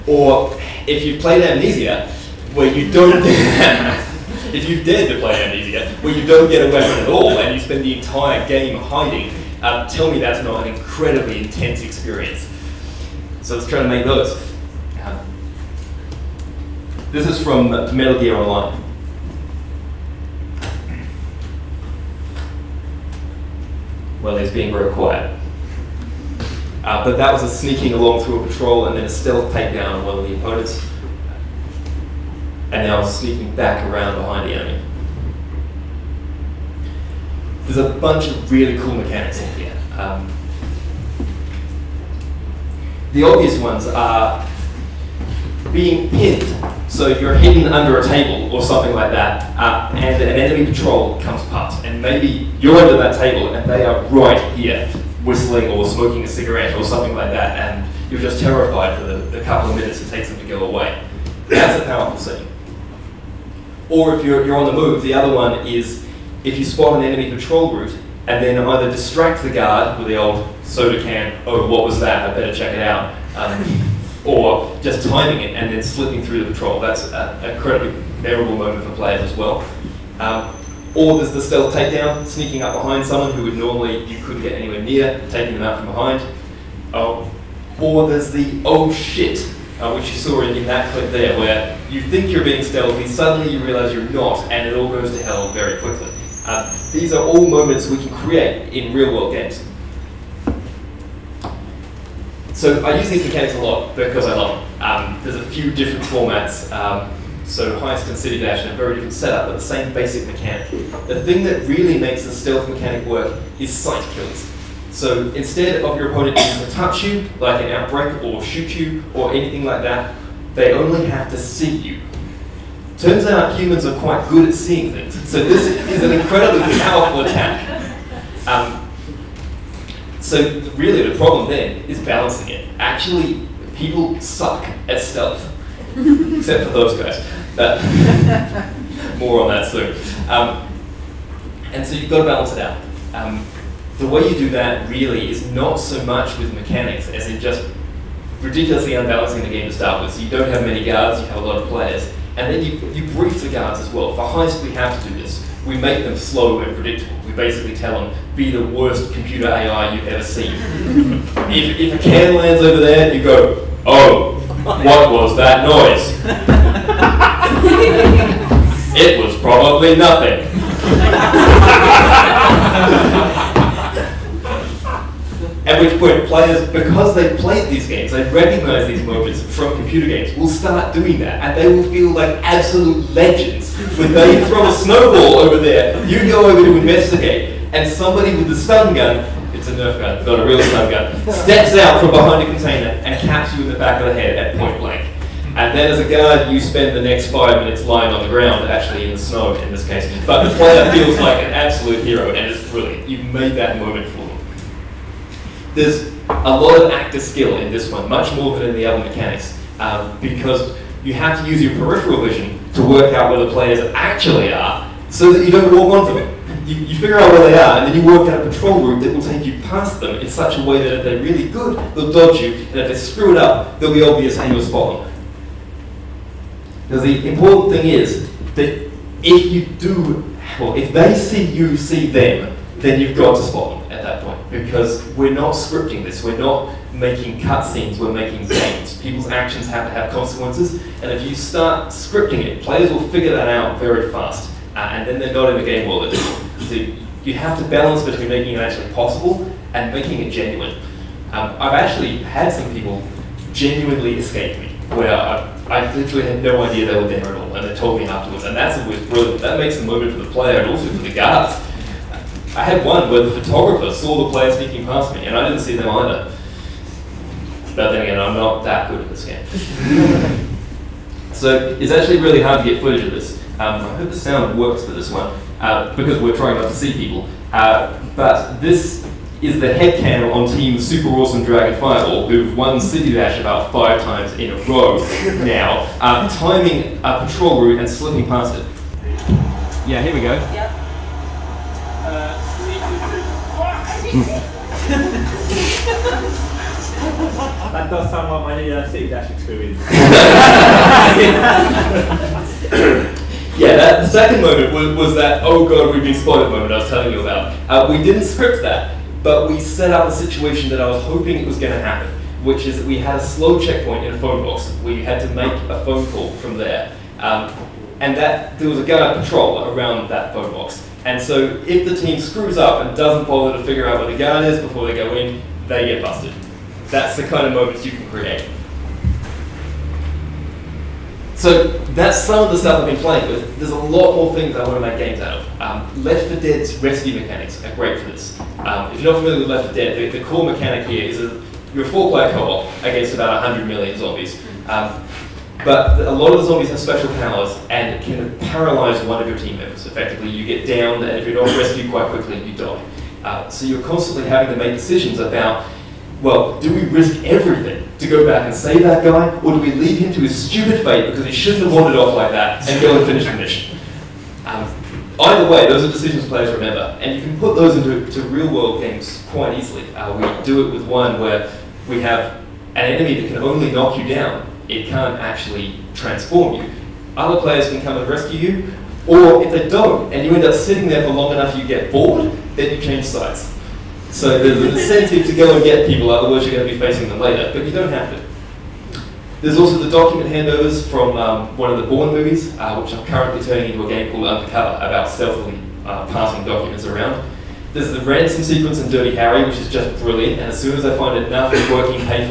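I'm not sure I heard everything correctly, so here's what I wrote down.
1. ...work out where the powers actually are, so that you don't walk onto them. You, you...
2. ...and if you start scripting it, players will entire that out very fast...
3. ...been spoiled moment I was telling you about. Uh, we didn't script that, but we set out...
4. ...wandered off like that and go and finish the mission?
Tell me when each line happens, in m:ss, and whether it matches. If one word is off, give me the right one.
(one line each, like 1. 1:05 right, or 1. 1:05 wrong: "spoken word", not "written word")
1. 3:32 wrong: "players", not "powers"
2. 4:01 wrong: "figure", not "entire"
3. 5:06 right
4. 6:01 right.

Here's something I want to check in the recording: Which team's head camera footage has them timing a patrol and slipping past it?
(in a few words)
Team Super Awesome Dragon Fireball.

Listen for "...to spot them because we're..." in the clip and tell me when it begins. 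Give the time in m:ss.
3:53.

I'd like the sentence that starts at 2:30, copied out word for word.
So you don't have many guards, you have a lot of players, and then you, you brief the guards as well.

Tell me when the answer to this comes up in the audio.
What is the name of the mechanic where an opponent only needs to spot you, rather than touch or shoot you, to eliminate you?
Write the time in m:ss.
1:53.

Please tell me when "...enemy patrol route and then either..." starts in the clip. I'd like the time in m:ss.
1:07.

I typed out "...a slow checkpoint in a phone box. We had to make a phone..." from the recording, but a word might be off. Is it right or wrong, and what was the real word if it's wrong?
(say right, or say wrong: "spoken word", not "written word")
right.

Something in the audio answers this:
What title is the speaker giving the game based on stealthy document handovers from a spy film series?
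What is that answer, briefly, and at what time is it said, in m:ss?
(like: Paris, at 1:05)
Undercover, at 6:34.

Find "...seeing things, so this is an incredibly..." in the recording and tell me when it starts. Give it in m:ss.
2:04.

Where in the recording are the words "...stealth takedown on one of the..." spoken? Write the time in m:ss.
0:29.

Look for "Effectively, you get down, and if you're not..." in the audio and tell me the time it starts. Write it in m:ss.
5:49.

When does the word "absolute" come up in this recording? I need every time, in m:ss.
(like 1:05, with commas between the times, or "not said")
3:02, 3:21.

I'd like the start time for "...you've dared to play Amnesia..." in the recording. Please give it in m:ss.
0:04.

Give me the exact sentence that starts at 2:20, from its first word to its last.
Um, and so you've got to balance it out.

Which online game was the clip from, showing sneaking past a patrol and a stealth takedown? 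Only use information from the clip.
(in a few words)
Metal Gear Online.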